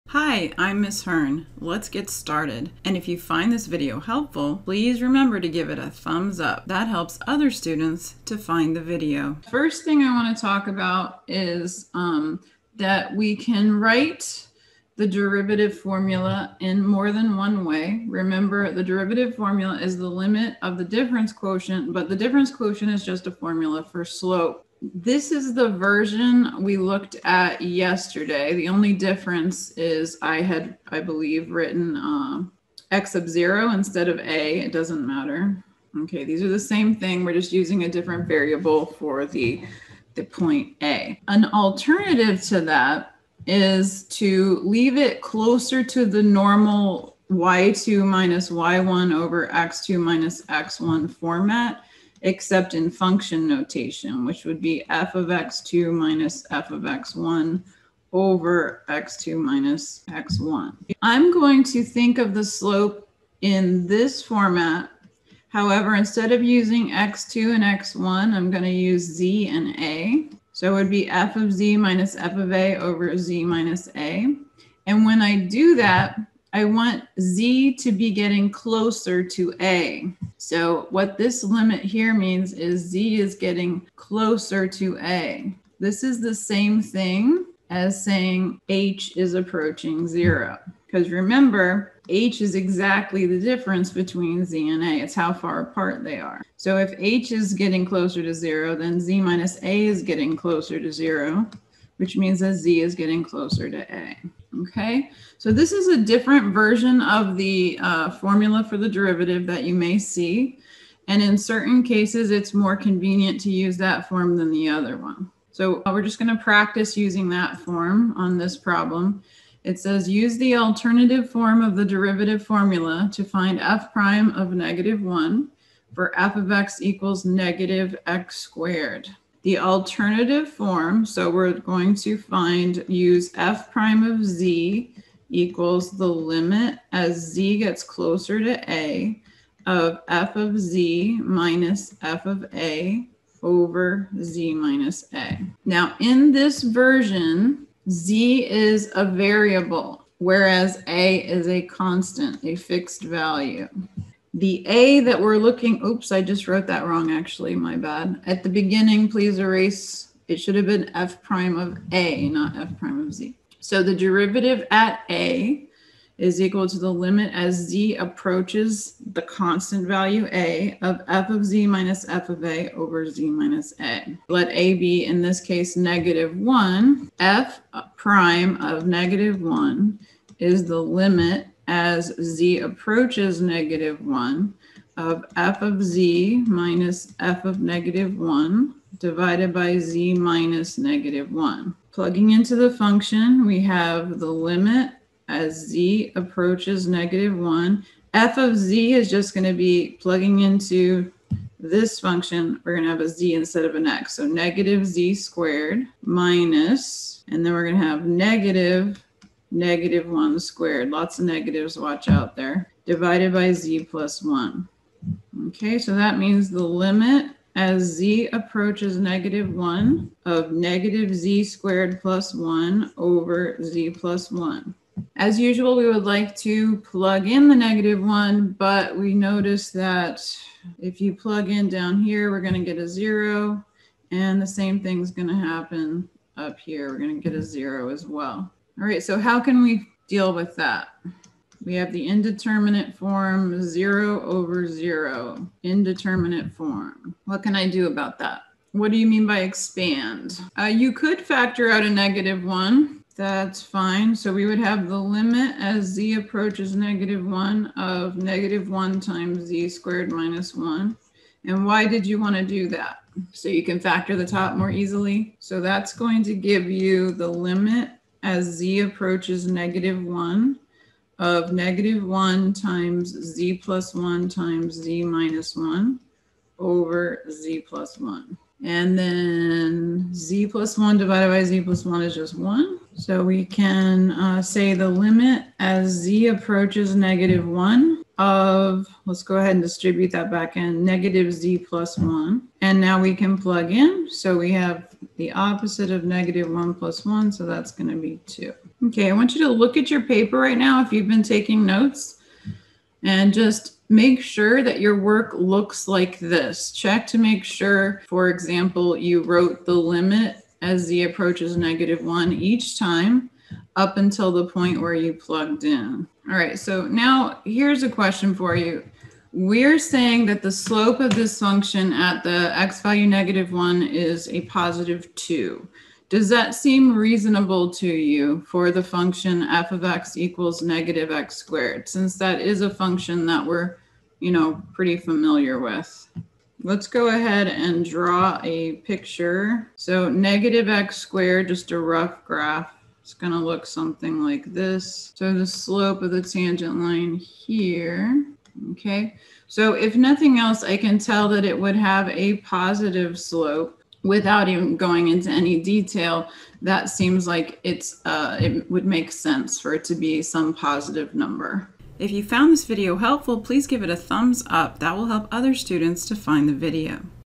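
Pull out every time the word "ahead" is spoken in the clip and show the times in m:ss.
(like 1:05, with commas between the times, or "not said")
4:49, 5:37.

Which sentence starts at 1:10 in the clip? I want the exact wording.
So it would be f of z minus f of a over z minus a.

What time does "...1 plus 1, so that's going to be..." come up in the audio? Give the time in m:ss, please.
4:56.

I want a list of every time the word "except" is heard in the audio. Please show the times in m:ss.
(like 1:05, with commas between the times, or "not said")
0:52.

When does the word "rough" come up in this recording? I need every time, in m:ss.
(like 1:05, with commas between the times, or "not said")
5:41.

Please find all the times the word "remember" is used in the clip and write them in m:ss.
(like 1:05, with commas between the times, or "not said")
0:05, 0:18, 1:31.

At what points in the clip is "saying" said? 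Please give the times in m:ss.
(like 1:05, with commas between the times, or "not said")
1:28, 5:19.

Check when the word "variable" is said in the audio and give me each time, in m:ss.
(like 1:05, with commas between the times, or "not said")
0:38, 2:29.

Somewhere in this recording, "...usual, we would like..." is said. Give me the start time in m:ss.
3:45.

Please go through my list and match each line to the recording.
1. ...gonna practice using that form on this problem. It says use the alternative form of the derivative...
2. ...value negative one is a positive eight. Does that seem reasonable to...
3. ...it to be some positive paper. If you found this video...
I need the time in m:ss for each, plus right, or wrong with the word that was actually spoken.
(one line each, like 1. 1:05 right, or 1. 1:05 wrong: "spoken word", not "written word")
1. 1:56 right
2. 5:22 wrong: "two", not "eight"
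3. 5:59 wrong: "number", not "paper".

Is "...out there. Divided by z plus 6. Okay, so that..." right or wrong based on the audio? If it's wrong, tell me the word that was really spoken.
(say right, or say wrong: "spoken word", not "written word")
wrong: "1", not "6".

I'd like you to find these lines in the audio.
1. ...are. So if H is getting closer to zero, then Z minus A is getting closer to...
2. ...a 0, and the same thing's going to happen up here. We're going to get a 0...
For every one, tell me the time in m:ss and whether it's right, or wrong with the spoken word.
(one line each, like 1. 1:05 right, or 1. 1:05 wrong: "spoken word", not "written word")
1. 1:36 right
2. 3:52 right.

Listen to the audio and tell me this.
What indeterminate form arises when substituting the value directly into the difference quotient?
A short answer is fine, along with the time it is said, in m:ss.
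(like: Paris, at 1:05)
0 over 0, at 4:03.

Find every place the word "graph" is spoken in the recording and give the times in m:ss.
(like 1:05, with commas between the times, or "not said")
5:42.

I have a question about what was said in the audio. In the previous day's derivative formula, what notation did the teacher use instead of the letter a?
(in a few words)
x sub 0.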